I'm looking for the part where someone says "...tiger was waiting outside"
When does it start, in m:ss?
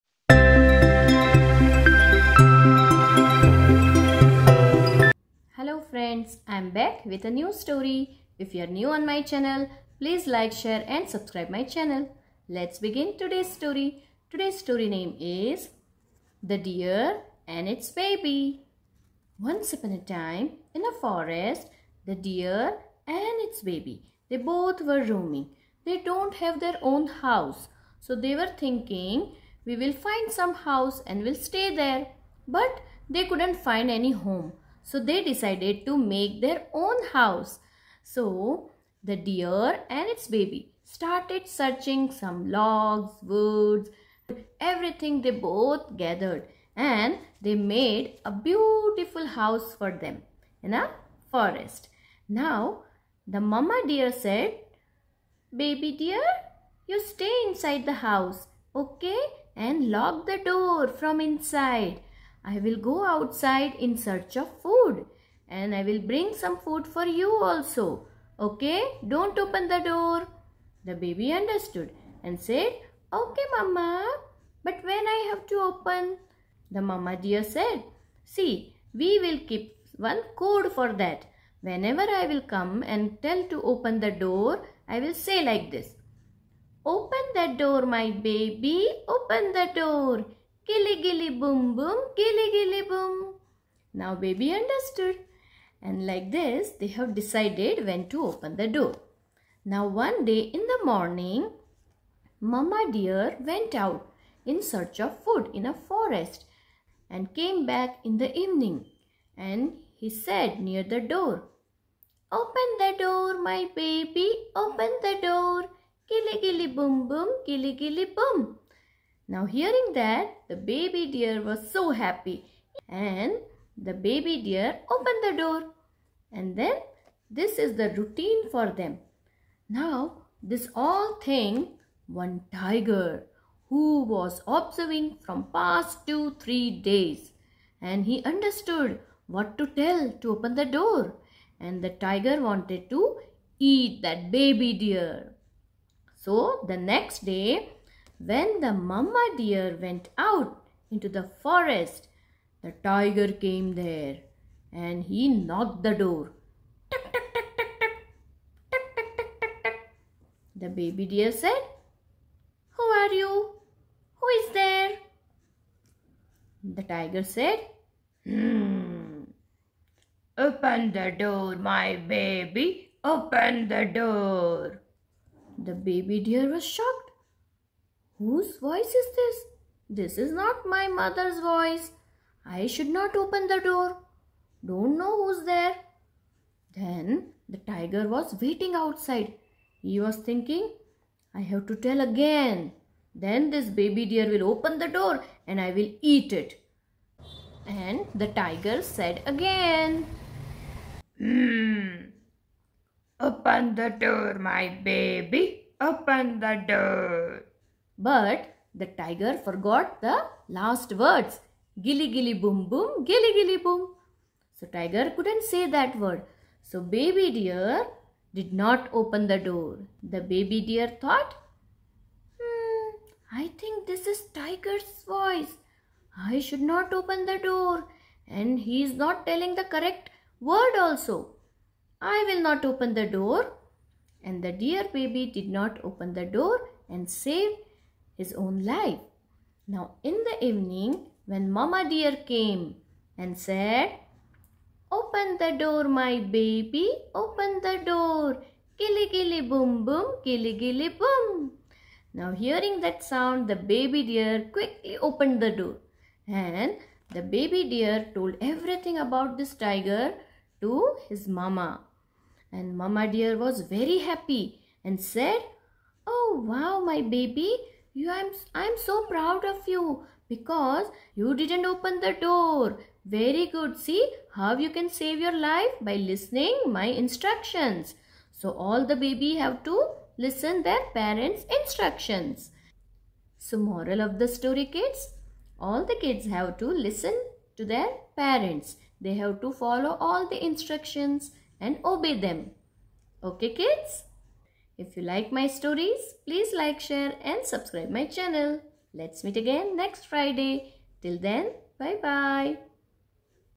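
3:07.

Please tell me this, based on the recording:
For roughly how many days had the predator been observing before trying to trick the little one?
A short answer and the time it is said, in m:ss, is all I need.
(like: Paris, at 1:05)
2 or 3 days, at 2:16.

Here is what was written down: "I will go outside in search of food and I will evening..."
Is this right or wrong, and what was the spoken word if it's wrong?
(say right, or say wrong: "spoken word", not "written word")
wrong: "bring", not "evening".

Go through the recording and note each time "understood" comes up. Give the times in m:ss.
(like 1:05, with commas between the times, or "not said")
1:11, 1:34, 2:18.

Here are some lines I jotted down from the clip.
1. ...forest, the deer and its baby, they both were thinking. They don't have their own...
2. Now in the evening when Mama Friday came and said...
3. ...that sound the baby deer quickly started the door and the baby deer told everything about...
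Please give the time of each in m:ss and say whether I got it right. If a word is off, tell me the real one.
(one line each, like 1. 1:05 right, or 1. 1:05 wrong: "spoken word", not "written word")
1. 0:21 wrong: "roaming", not "thinking"
2. 3:59 wrong: "Deer", not "Friday"
3. 4:12 wrong: "opened", not "started".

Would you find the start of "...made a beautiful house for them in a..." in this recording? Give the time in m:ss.
0:47.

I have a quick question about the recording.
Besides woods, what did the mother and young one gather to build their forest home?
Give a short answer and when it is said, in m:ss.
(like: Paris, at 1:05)
logs, at 0:42.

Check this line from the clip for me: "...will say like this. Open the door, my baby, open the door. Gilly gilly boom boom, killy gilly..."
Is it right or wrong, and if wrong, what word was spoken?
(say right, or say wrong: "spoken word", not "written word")
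wrong: "gilly", not "killy".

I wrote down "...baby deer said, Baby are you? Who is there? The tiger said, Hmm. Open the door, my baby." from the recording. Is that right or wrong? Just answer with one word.
wrong.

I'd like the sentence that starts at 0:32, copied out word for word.
But they couldn't find any home.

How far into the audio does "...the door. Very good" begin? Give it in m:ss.
4:31.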